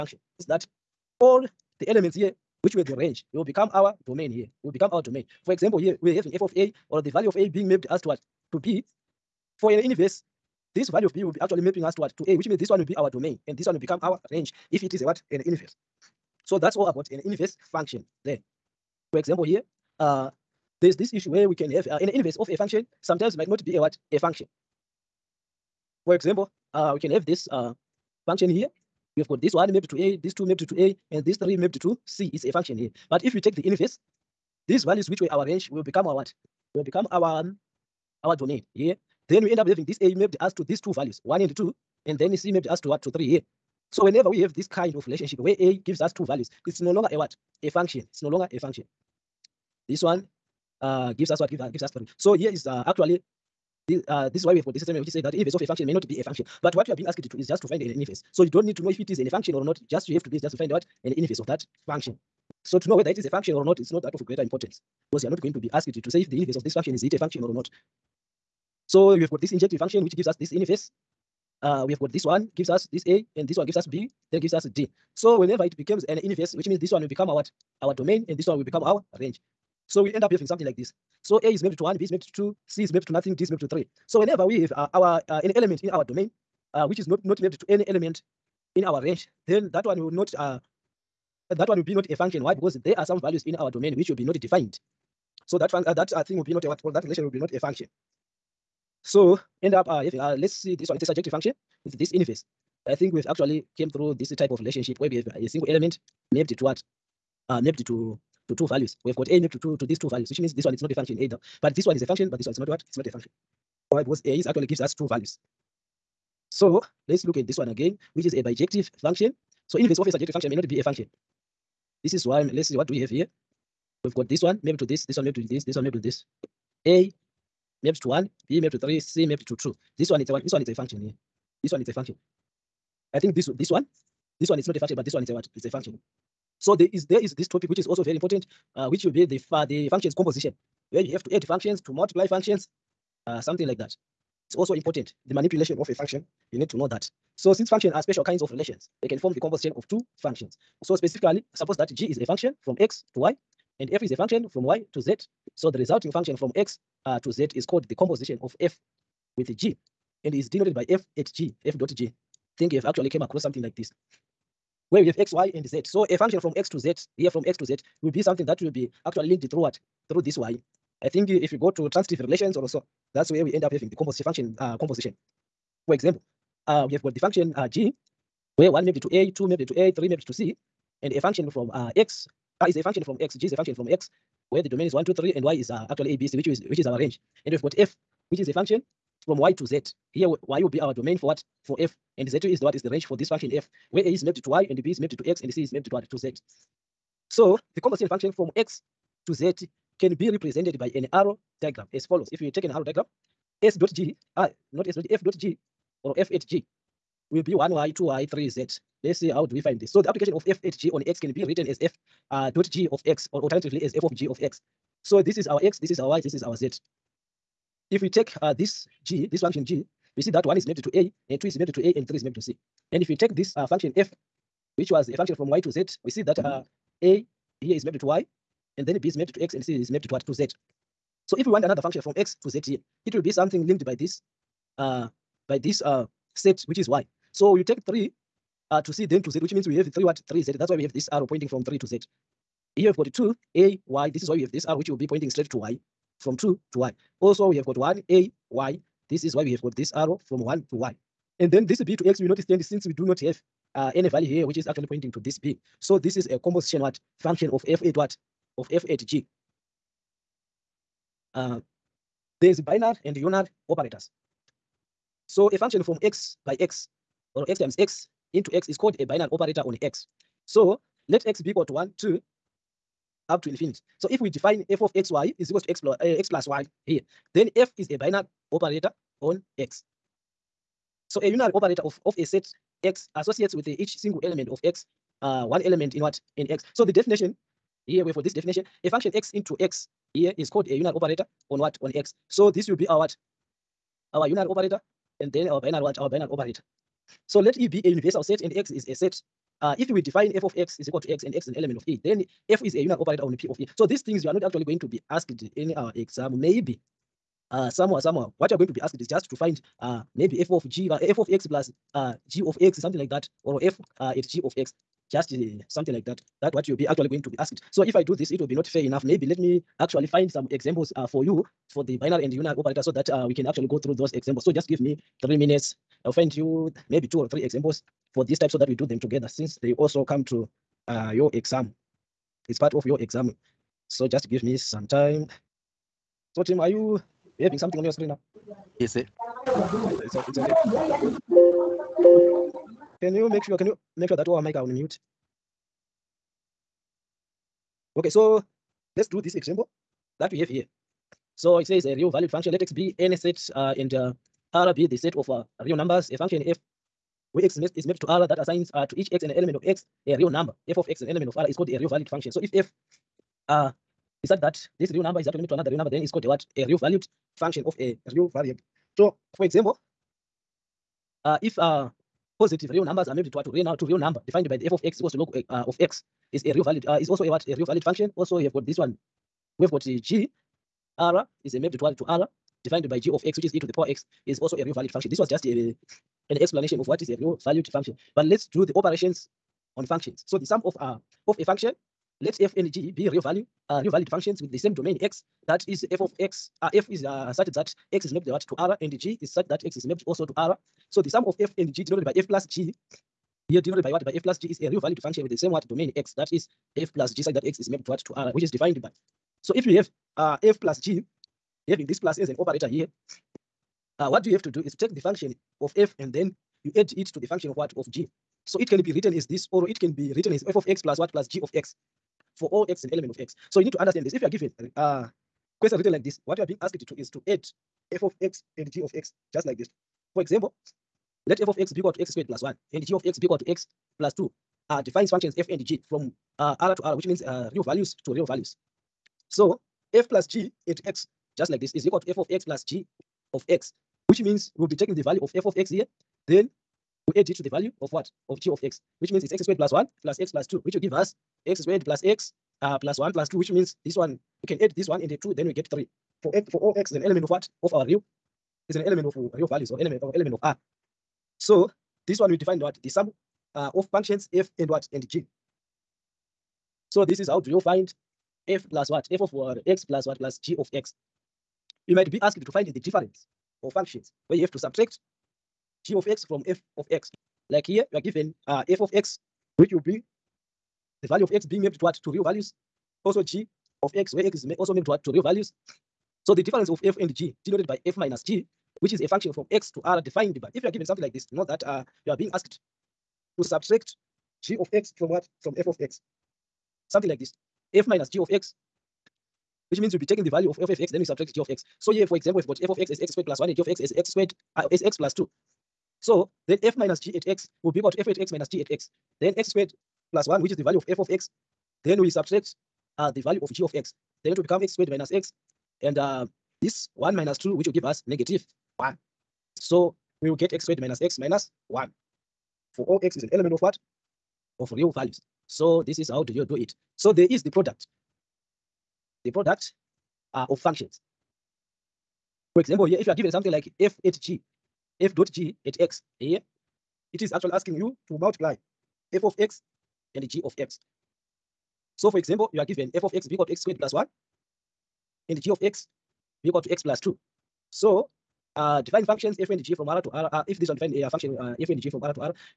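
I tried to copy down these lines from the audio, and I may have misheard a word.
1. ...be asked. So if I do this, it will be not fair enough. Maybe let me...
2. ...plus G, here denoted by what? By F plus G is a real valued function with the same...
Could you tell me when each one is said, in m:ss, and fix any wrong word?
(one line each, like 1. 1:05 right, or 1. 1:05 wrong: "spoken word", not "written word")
1. 5:17 right
2. 6:42 right.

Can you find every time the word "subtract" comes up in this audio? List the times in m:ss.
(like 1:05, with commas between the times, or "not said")
7:54, 8:13, 8:21, 8:32.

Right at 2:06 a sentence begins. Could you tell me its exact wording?
A Maybe to one, B Maybe to three, C Maybe to two.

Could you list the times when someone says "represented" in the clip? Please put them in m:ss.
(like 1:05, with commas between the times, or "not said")
3:20.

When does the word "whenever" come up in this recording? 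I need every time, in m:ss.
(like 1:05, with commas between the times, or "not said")
0:44, 1:15, 1:24.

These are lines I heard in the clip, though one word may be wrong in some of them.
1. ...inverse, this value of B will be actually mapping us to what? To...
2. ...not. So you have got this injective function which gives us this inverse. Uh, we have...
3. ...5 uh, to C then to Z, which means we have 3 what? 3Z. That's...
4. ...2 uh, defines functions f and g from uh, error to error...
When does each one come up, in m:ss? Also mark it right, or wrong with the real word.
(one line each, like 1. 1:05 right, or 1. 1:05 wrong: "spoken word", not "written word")
1. 0:09 right
2. 1:07 right
3. 3:57 wrong: "3", not "5"
4. 7:14 right.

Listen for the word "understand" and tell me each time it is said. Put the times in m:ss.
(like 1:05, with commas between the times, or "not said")
7:03.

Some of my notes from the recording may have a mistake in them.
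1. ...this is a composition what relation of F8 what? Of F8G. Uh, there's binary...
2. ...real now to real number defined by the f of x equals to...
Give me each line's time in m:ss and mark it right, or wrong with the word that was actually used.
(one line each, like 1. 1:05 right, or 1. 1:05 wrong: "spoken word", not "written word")
1. 4:15 wrong: "function", not "relation"
2. 6:13 right.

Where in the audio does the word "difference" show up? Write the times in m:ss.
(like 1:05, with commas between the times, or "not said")
7:52, 8:06.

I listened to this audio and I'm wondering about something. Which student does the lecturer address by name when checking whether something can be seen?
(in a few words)
Tim.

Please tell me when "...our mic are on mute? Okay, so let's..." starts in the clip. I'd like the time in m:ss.
5:44.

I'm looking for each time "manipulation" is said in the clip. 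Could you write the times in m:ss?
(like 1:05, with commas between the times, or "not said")
2:25.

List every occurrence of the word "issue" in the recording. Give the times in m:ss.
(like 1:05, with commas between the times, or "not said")
0:21.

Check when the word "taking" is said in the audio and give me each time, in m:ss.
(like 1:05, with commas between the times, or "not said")
7:24, 8:20.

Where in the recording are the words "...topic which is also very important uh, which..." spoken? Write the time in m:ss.
2:17.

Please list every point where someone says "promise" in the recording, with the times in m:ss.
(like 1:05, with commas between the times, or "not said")
not said.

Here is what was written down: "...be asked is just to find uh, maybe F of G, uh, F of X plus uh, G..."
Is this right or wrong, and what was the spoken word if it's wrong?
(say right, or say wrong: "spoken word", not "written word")
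right.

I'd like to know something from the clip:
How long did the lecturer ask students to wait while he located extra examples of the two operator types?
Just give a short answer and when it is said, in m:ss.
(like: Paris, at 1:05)
3 minutes, at 5:25.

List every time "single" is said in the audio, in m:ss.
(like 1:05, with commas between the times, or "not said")
1:45, 4:43.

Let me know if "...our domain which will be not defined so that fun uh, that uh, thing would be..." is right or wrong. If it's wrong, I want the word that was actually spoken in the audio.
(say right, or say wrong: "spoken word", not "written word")
right.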